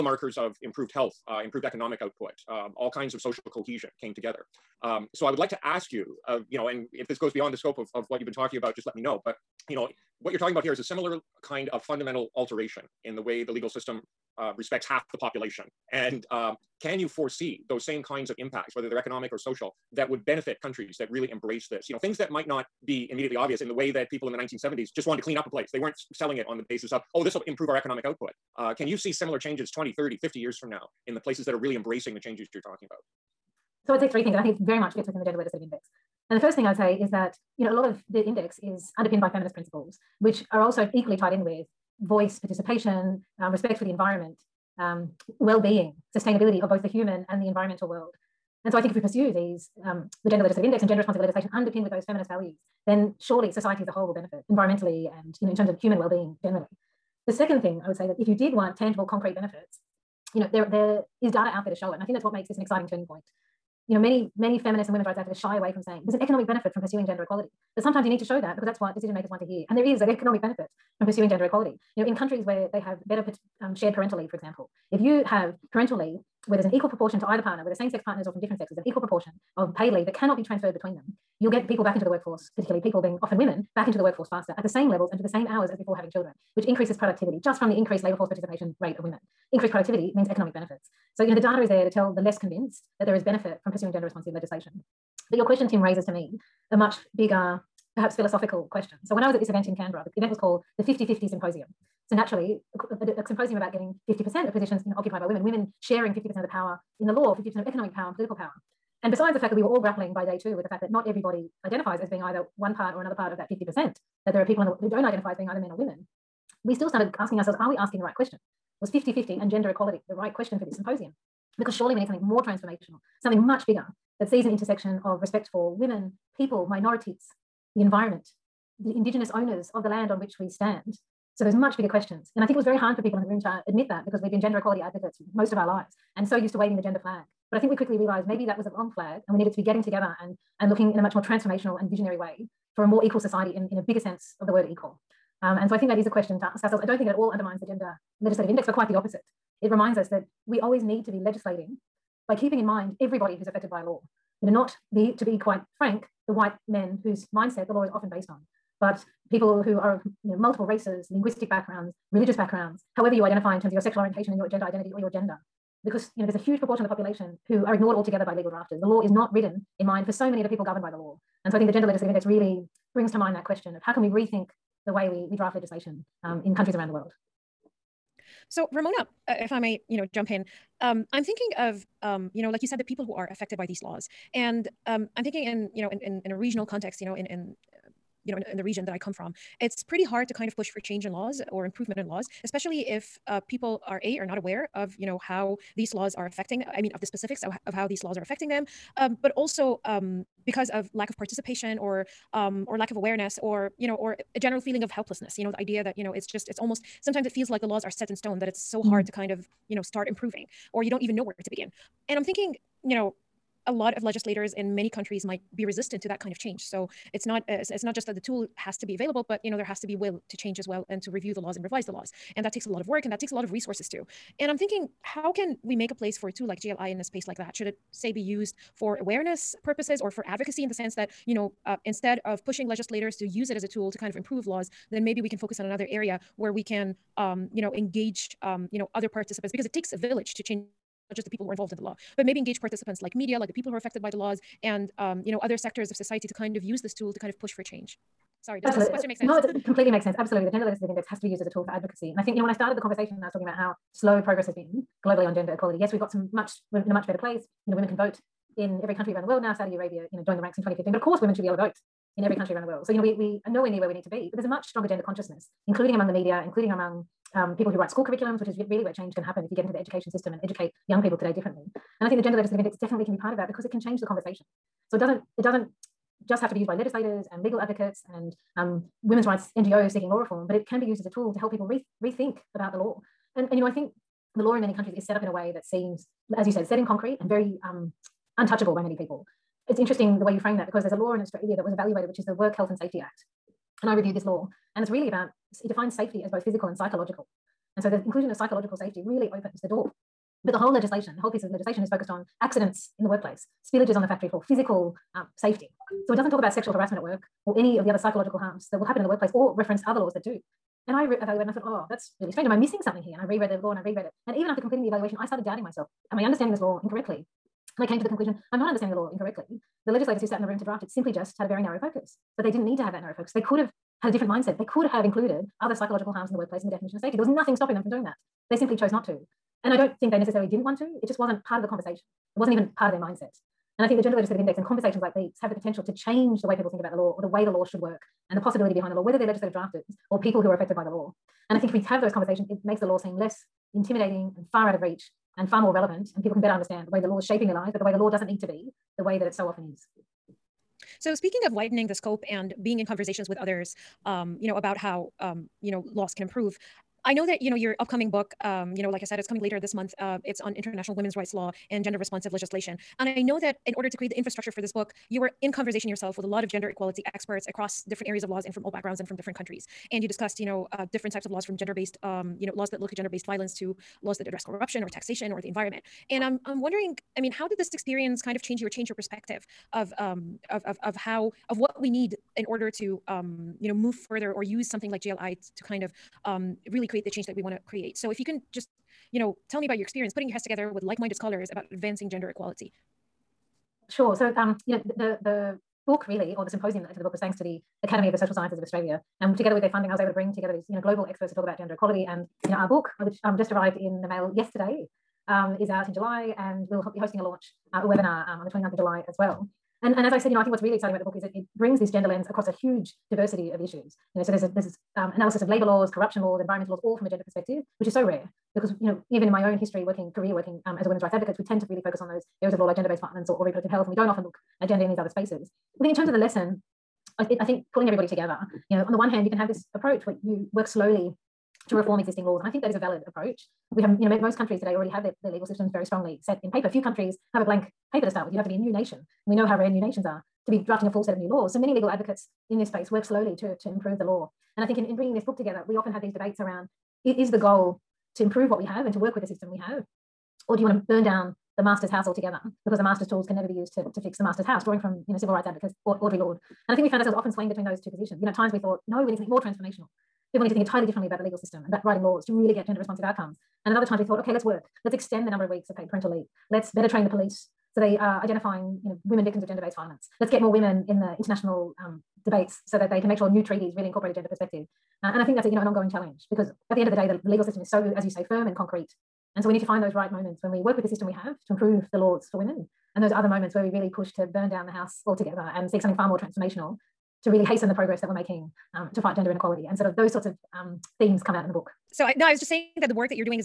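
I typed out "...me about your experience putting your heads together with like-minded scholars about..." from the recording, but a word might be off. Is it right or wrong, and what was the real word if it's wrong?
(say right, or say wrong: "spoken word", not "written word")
right.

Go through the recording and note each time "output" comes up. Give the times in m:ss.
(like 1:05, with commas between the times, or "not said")
0:02, 0:28.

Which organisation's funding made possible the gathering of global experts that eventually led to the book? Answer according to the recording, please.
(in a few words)
Academy of the Social Sciences of Australia.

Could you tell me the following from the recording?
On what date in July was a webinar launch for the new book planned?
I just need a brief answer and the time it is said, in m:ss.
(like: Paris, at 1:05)
29 July, at 6:48.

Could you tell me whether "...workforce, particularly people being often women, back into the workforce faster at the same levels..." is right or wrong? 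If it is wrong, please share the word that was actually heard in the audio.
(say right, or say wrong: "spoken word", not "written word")
right.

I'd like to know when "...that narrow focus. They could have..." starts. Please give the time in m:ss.
5:22.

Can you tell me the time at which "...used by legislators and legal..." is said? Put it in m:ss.
4:36.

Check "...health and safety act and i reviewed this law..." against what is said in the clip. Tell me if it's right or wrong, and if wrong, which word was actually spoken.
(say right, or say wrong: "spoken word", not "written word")
right.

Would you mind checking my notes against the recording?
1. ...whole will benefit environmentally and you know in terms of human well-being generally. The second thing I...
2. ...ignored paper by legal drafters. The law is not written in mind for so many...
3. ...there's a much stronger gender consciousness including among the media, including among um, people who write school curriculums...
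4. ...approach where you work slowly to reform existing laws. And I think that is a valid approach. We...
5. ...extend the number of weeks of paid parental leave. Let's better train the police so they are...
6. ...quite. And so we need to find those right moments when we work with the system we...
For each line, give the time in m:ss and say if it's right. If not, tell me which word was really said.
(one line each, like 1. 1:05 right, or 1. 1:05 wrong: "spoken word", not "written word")
1. 0:53 right
2. 2:47 wrong: "altogether", not "paper"
3. 4:24 right
4. 7:09 right
5. 7:44 right
6. 7:58 wrong: "concrete", not "quite".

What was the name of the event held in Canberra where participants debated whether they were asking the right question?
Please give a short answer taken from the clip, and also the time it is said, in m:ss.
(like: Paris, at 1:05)
50 50 Symposium, at 1:40.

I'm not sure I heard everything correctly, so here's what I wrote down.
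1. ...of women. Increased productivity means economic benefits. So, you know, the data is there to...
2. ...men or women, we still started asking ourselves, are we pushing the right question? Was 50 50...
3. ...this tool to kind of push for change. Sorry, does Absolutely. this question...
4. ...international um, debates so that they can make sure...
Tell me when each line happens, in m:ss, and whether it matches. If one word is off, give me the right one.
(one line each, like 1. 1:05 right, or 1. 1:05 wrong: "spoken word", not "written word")
1. 1:28 right
2. 1:55 wrong: "asking", not "pushing"
3. 4:06 right
4. 7:51 right.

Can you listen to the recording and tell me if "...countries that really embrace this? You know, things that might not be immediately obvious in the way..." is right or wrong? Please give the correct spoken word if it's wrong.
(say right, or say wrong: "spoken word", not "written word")
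right.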